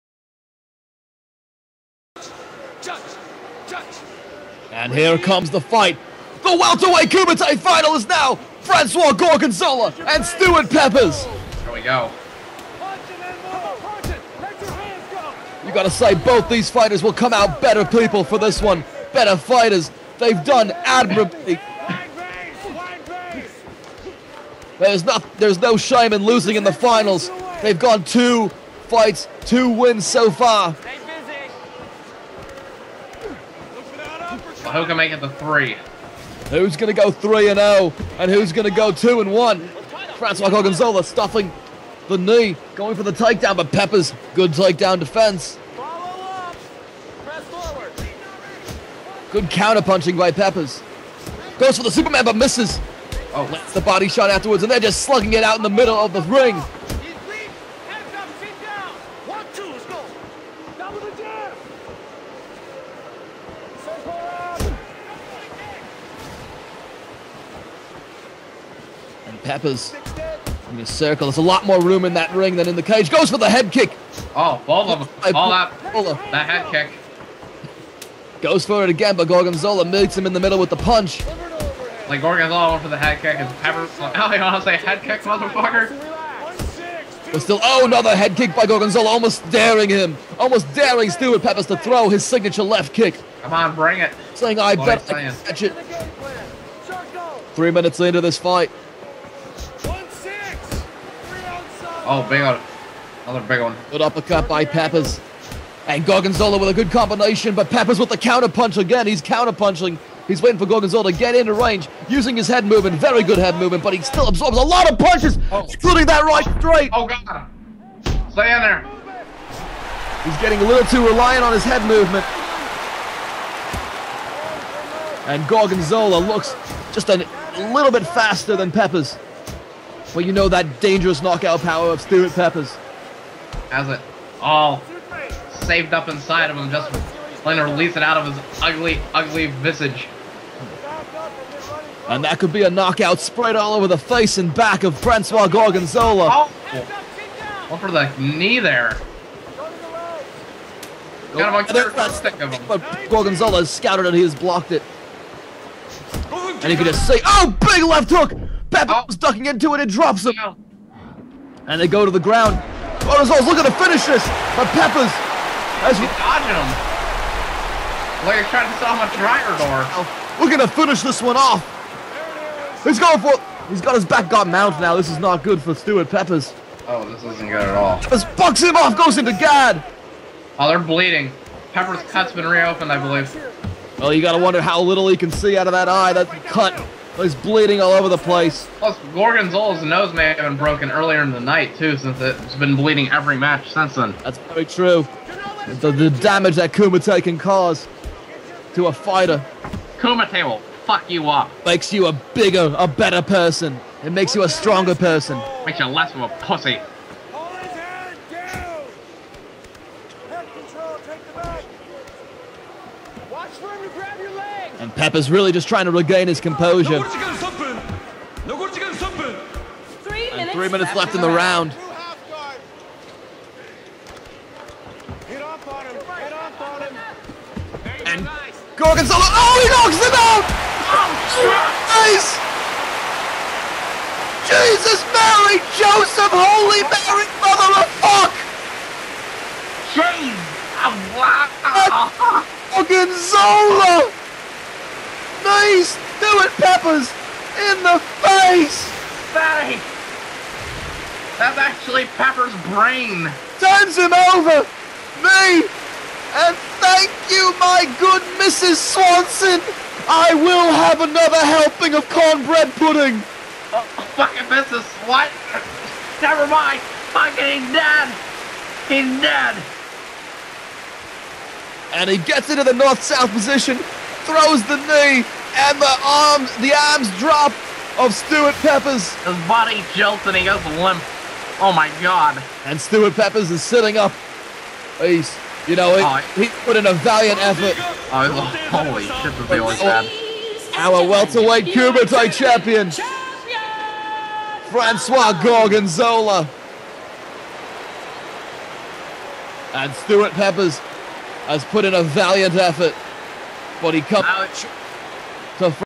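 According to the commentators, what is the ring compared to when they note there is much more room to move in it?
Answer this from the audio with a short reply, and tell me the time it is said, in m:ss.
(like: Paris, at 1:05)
the cage, at 1:12.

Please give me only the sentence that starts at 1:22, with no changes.
Like Gorgonzola went for the head kick and Pepper.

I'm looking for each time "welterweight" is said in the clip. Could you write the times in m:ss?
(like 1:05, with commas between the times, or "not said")
0:06, 4:51.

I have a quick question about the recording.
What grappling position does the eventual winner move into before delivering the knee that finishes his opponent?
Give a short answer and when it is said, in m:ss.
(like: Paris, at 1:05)
north-south, at 4:32.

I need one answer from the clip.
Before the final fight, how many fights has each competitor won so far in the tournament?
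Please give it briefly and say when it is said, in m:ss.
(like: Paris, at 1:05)
2, at 0:29.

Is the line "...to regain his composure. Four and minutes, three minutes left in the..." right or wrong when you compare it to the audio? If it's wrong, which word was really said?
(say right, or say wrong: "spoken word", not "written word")
wrong: "Three", not "Four".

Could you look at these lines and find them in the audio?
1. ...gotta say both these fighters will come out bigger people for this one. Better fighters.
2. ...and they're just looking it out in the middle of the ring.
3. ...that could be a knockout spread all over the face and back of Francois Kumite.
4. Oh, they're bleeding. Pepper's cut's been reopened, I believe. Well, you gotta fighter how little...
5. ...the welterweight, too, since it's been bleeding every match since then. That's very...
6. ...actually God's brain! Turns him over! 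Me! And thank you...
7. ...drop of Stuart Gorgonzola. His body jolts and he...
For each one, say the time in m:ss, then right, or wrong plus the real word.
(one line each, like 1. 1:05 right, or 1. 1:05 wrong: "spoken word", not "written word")
1. 0:15 wrong: "better", not "bigger"
2. 0:54 wrong: "slugging", not "looking"
3. 2:22 wrong: "Gorgonzola", not "Kumite"
4. 3:00 wrong: "wonder", not "fighter"
5. 3:11 wrong: "night", not "welterweight"
6. 4:11 wrong: "Pepper", not "God"
7. 4:37 wrong: "Peppers", not "Gorgonzola".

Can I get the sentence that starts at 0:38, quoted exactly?
And who's going to go 2 and 1?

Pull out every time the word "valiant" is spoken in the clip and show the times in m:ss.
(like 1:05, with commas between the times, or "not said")
4:46, 5:02.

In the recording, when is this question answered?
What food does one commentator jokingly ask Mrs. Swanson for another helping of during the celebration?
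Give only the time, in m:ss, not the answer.
4:22.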